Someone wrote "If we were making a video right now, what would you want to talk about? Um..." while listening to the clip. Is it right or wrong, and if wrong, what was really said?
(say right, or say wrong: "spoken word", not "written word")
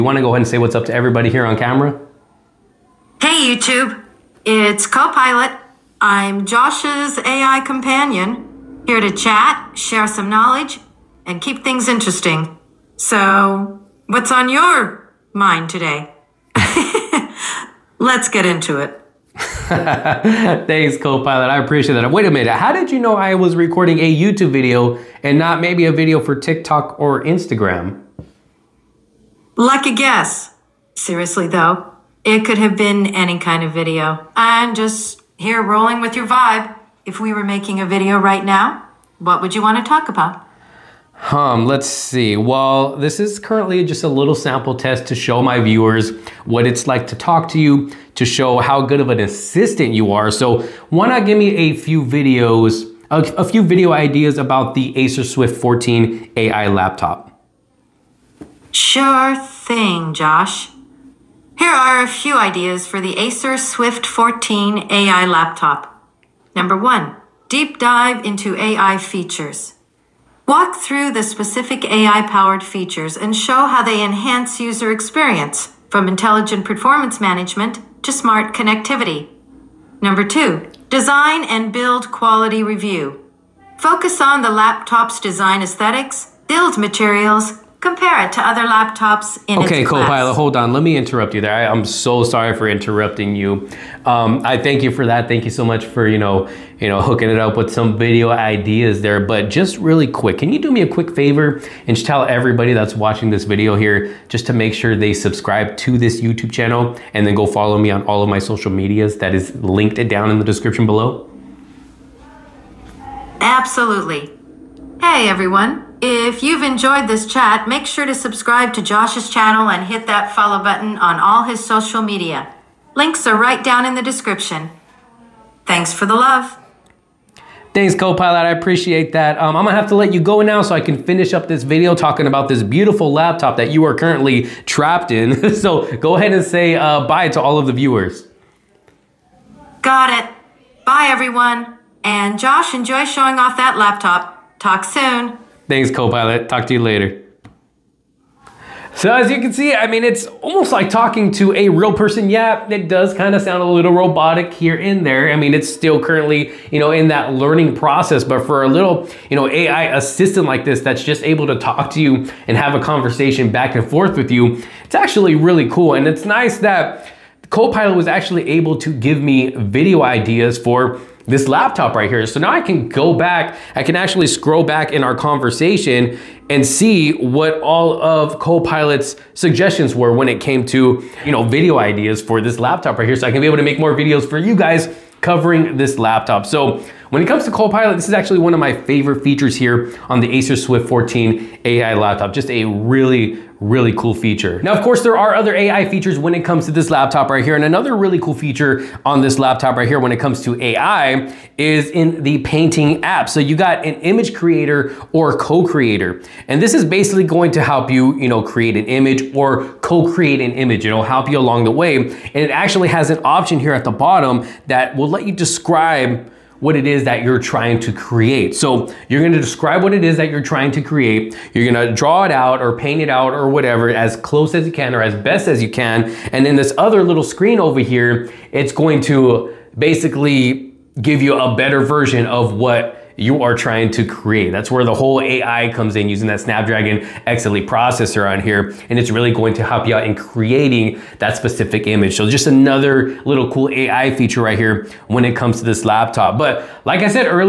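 right.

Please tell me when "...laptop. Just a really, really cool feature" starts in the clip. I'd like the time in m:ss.
3:11.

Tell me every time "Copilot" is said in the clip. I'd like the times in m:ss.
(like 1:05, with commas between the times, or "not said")
0:04, 0:20, 1:29, 2:07, 2:25, 2:47, 2:58, 3:07.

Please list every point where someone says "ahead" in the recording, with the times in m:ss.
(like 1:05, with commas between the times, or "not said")
0:00, 2:16.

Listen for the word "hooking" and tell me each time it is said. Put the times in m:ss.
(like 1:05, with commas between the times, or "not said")
1:37.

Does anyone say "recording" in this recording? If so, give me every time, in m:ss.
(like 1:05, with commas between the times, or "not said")
0:23.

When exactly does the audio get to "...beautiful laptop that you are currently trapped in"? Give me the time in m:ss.
2:12.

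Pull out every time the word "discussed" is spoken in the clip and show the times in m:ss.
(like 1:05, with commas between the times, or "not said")
not said.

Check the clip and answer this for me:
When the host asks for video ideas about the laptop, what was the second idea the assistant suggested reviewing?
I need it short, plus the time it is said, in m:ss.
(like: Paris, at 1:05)
Design and build quality, at 1:20.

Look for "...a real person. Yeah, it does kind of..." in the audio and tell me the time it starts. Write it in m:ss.
2:31.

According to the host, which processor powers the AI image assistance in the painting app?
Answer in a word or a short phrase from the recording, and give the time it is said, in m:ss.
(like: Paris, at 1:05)
Snapdragon X Elite, at 3:56.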